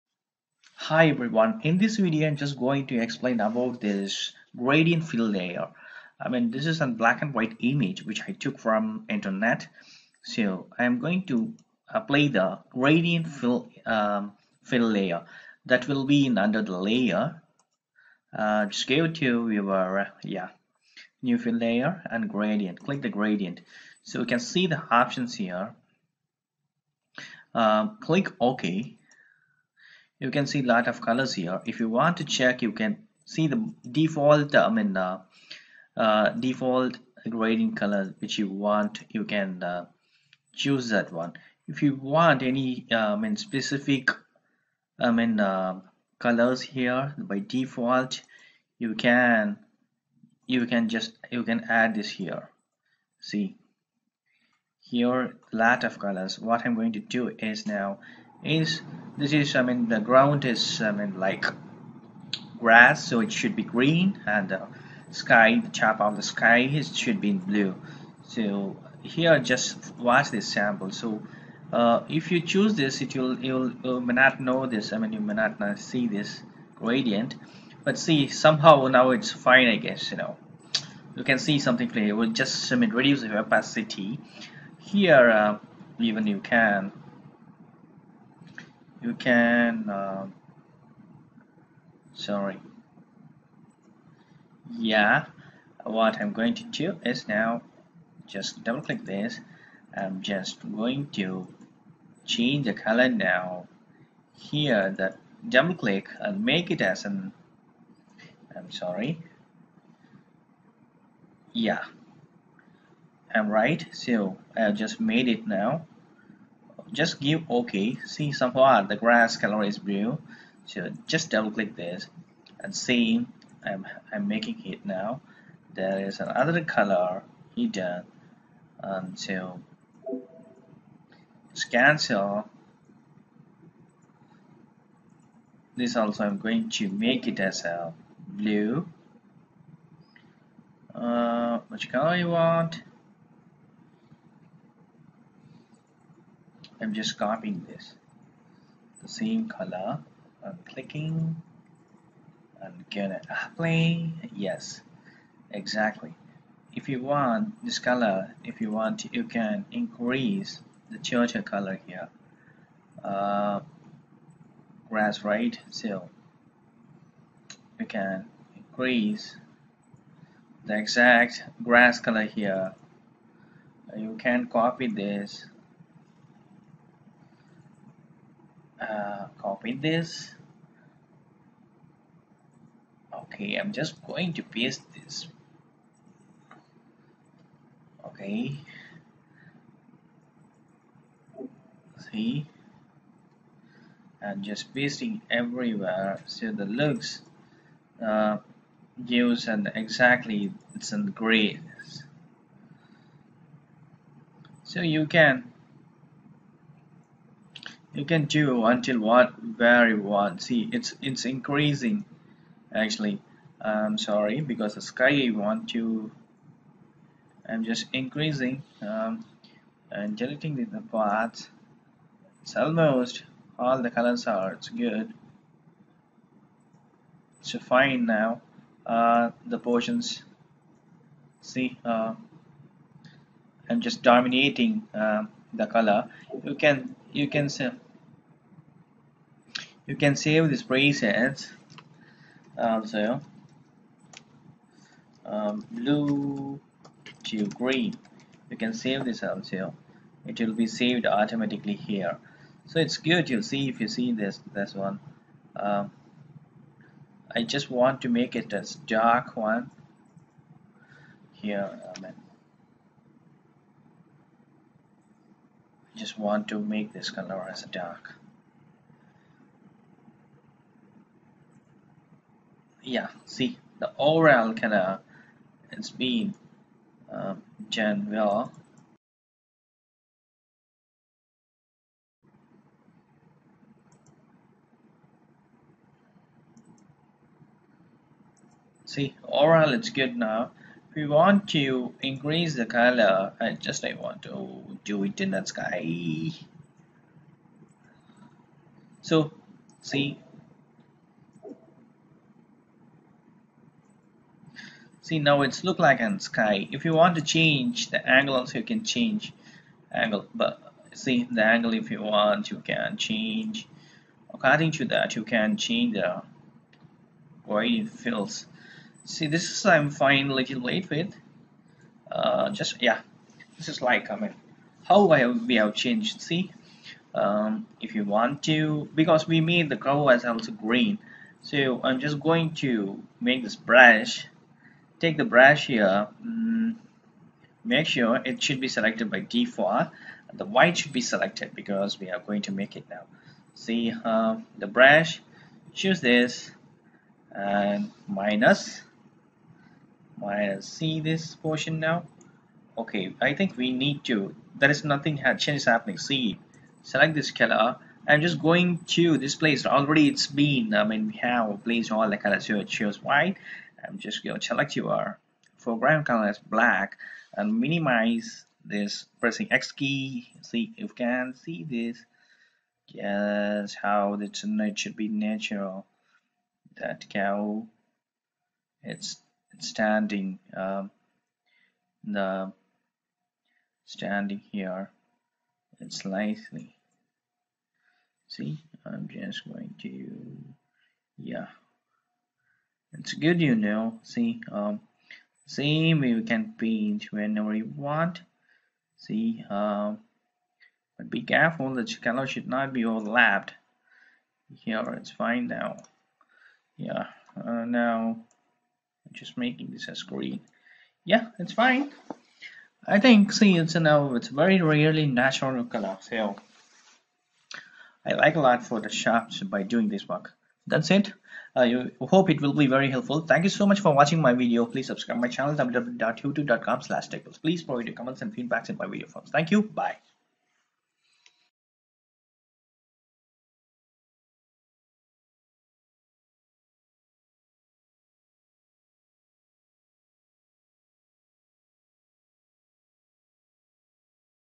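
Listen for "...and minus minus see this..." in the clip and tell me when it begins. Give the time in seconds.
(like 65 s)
347 s.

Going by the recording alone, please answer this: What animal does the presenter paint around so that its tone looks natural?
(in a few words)
Cow.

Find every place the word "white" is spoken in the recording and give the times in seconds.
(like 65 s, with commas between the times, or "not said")
7 s, 340 s, 363 s.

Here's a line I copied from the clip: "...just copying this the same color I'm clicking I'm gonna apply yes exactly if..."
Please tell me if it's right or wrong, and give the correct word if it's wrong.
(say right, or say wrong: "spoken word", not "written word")
right.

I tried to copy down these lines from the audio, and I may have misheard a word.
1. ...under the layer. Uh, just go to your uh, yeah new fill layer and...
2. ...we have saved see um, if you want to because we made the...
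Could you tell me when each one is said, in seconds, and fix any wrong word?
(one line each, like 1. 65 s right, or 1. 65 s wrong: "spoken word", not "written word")
1. 16 s right
2. 325 s wrong: "changed", not "saved".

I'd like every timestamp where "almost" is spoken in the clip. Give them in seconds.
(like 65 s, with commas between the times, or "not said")
222 s.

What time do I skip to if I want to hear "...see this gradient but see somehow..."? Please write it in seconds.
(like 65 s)
75 s.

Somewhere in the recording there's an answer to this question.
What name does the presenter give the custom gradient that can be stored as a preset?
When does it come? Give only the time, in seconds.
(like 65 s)
245 s.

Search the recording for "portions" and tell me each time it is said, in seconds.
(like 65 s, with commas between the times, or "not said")
229 s, 351 s.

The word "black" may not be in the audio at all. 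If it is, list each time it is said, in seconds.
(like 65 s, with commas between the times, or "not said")
6 s, 366 s.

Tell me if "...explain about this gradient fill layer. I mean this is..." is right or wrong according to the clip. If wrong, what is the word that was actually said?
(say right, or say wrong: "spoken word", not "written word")
right.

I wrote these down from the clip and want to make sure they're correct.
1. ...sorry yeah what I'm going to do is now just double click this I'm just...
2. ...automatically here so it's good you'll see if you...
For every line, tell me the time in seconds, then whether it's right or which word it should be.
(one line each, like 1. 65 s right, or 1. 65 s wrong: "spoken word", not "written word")
1. 92 s right
2. 251 s right.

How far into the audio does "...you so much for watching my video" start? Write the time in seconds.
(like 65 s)
423 s.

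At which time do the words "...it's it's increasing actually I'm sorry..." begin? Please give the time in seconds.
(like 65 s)
210 s.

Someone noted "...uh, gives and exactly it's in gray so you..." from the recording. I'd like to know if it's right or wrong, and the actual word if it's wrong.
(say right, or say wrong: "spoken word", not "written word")
right.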